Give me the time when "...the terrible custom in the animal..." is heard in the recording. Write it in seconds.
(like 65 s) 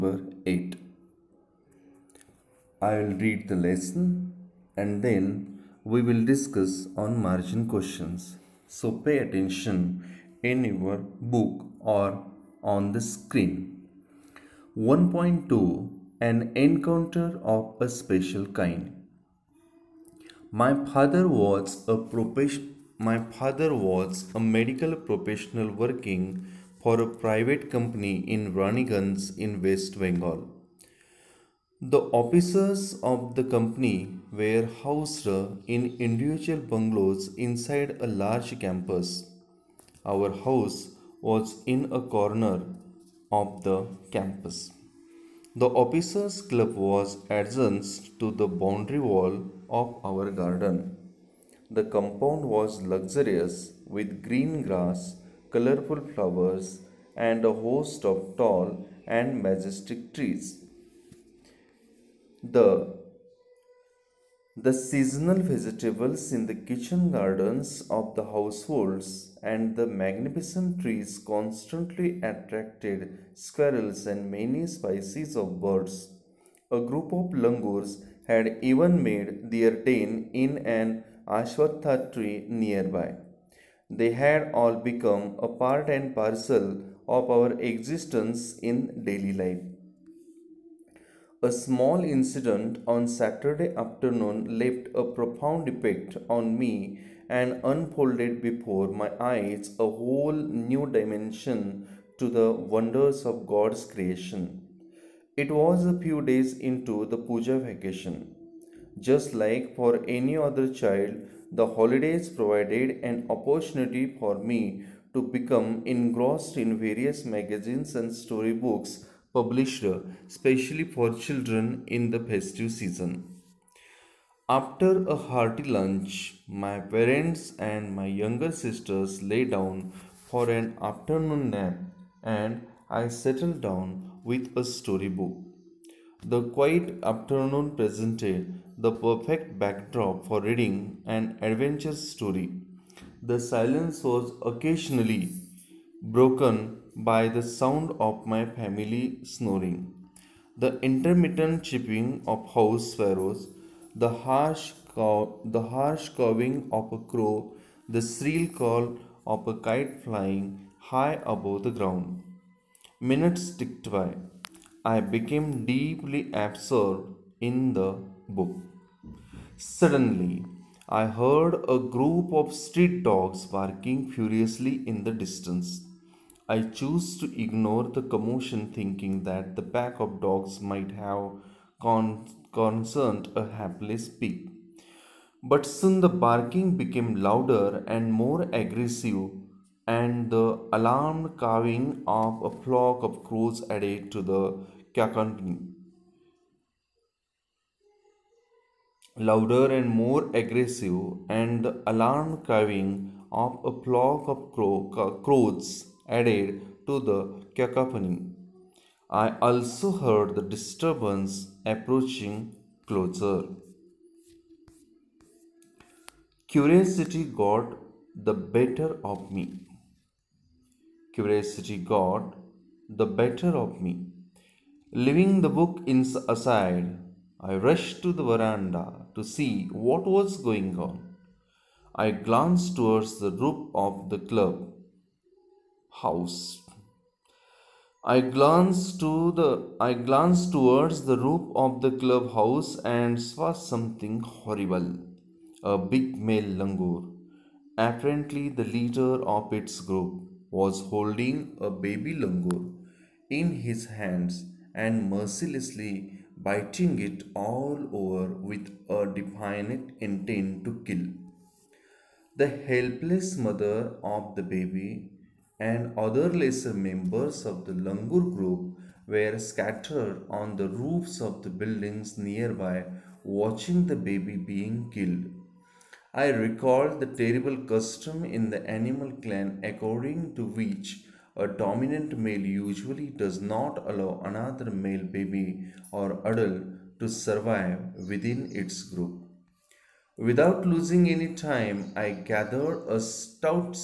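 276 s.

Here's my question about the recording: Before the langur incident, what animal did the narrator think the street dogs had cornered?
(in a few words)
a hapless pig.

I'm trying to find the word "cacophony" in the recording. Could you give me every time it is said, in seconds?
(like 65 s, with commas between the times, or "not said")
194 s, 207 s.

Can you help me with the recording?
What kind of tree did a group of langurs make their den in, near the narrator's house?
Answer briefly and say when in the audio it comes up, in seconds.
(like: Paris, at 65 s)
ashwatha tree, at 81 s.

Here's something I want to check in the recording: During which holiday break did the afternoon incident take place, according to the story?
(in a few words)
puja vacation.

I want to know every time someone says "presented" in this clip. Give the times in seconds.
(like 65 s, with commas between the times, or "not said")
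137 s.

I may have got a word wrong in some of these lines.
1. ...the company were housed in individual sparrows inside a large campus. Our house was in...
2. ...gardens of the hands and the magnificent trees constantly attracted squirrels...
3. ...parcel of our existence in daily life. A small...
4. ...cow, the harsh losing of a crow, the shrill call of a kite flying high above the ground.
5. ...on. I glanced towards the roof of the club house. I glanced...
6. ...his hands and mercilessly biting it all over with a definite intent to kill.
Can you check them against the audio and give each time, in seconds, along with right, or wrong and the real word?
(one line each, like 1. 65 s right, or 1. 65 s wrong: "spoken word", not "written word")
1. 33 s wrong: "bungalows", not "sparrows"
2. 67 s wrong: "households", not "hands"
3. 86 s right
4. 154 s wrong: "cawing", not "losing"
5. 230 s right
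6. 253 s right.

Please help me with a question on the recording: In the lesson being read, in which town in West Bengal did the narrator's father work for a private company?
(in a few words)
Raniganj.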